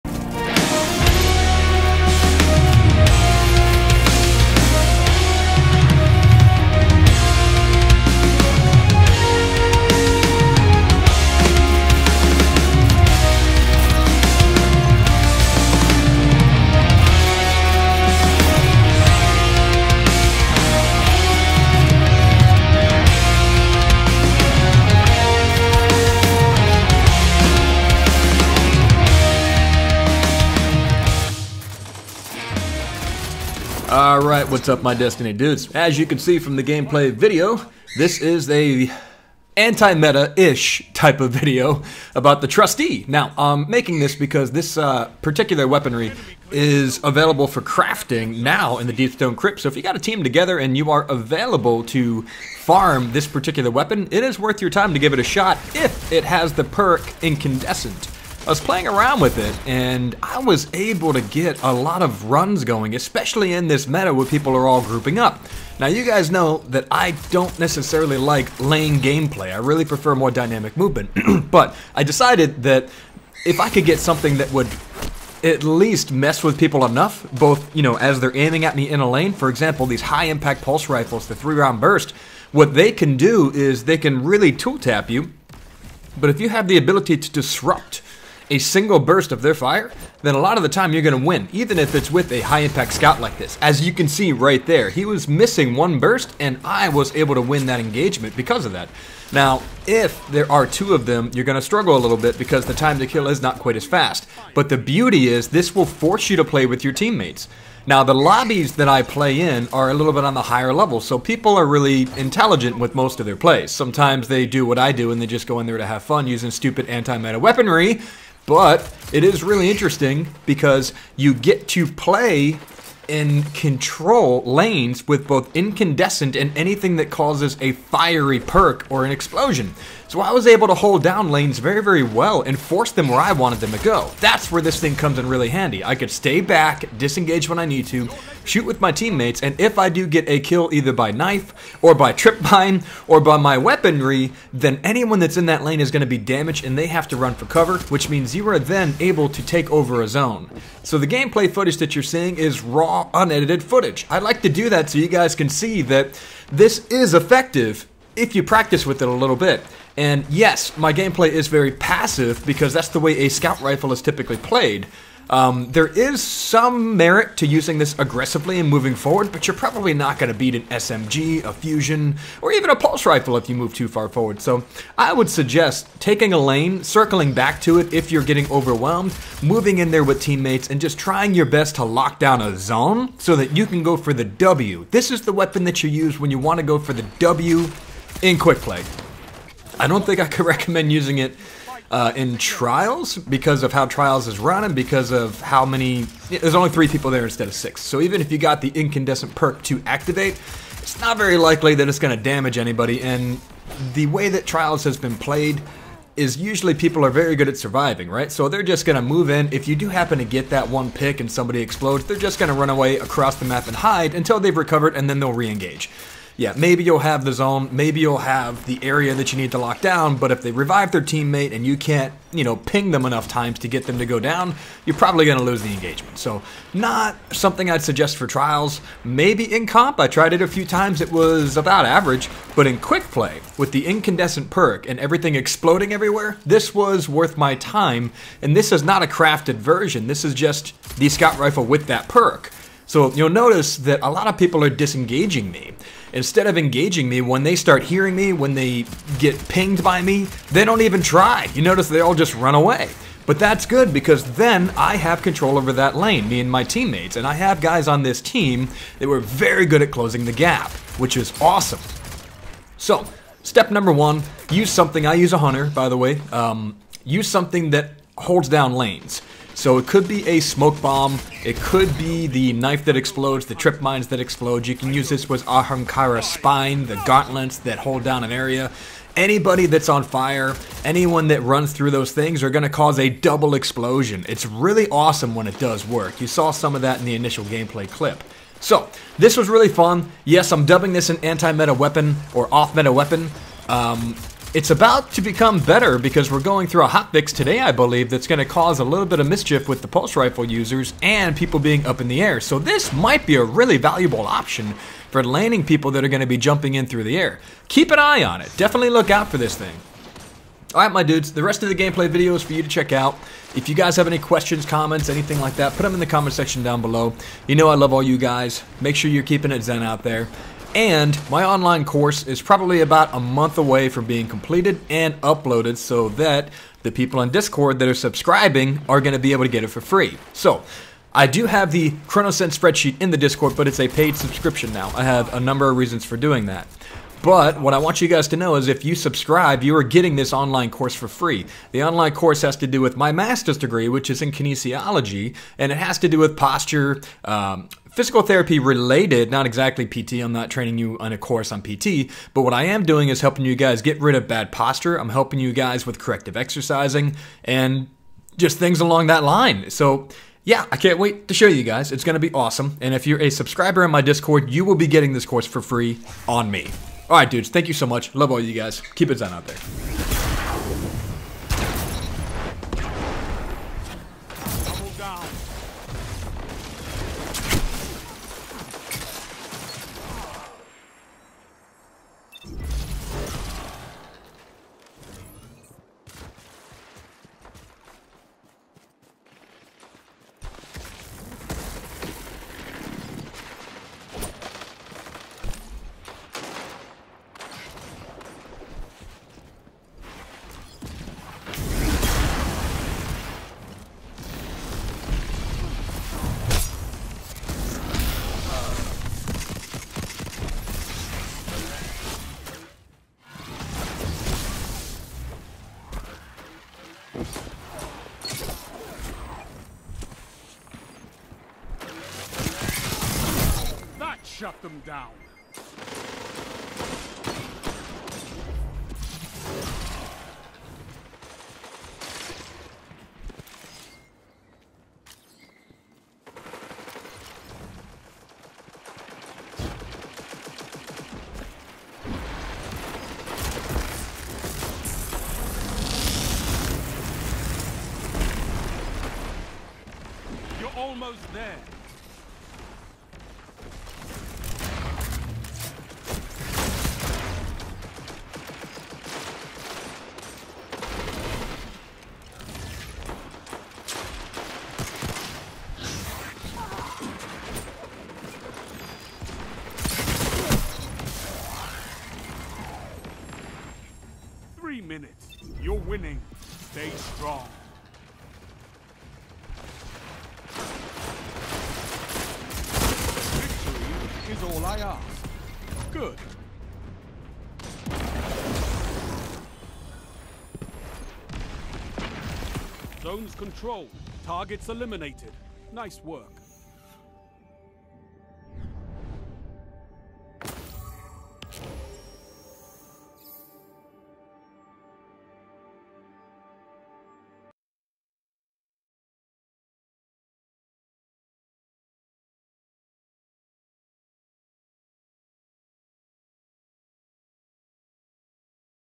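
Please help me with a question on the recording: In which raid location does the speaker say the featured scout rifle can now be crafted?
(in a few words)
Deepstone Crypt.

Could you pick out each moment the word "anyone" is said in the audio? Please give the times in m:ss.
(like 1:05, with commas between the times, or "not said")
2:24, 4:40.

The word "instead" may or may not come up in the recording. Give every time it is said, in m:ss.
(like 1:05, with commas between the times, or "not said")
3:17, 4:06.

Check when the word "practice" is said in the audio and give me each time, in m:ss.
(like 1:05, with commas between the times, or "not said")
2:38.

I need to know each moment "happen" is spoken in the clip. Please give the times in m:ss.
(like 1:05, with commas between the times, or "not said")
3:29.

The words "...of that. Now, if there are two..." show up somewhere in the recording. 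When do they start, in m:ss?
1:38.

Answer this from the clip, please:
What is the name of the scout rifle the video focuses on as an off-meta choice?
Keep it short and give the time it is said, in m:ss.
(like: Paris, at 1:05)
Trustee, at 0:42.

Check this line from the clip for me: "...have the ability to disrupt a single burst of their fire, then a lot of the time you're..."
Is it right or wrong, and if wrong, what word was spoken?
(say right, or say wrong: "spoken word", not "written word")
right.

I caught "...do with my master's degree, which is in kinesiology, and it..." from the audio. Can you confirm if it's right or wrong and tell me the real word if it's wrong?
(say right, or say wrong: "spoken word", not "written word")
right.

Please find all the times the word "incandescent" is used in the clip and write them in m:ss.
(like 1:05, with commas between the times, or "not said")
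0:57, 2:05, 3:18, 3:53.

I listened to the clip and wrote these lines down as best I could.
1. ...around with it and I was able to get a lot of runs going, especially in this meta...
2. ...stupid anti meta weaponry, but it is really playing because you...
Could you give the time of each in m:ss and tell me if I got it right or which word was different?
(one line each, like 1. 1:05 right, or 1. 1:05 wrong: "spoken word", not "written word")
1. 0:58 right
2. 1:56 wrong: "interesting", not "playing".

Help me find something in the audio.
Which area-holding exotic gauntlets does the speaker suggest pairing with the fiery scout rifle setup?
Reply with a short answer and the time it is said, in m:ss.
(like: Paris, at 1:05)
Ahamkara spine, at 4:35.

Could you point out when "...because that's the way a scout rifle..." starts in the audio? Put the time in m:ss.
2:42.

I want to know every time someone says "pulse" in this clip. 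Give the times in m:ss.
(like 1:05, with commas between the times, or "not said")
1:20, 2:52, 4:59.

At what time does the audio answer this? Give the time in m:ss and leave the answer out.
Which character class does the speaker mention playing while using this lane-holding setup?
4:25.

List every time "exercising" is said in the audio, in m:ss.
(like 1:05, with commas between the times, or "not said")
5:56.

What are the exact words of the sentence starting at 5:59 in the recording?
So, yeah, I can't wait to show you guys.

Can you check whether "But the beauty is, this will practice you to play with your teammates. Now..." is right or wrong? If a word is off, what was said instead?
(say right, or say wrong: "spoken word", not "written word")
wrong: "force", not "practice".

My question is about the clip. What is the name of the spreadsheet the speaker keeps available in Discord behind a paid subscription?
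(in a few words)
Chronosense spreadsheet.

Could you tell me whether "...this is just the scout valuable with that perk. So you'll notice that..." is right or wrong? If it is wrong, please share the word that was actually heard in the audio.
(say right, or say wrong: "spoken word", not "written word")
wrong: "rifle", not "valuable".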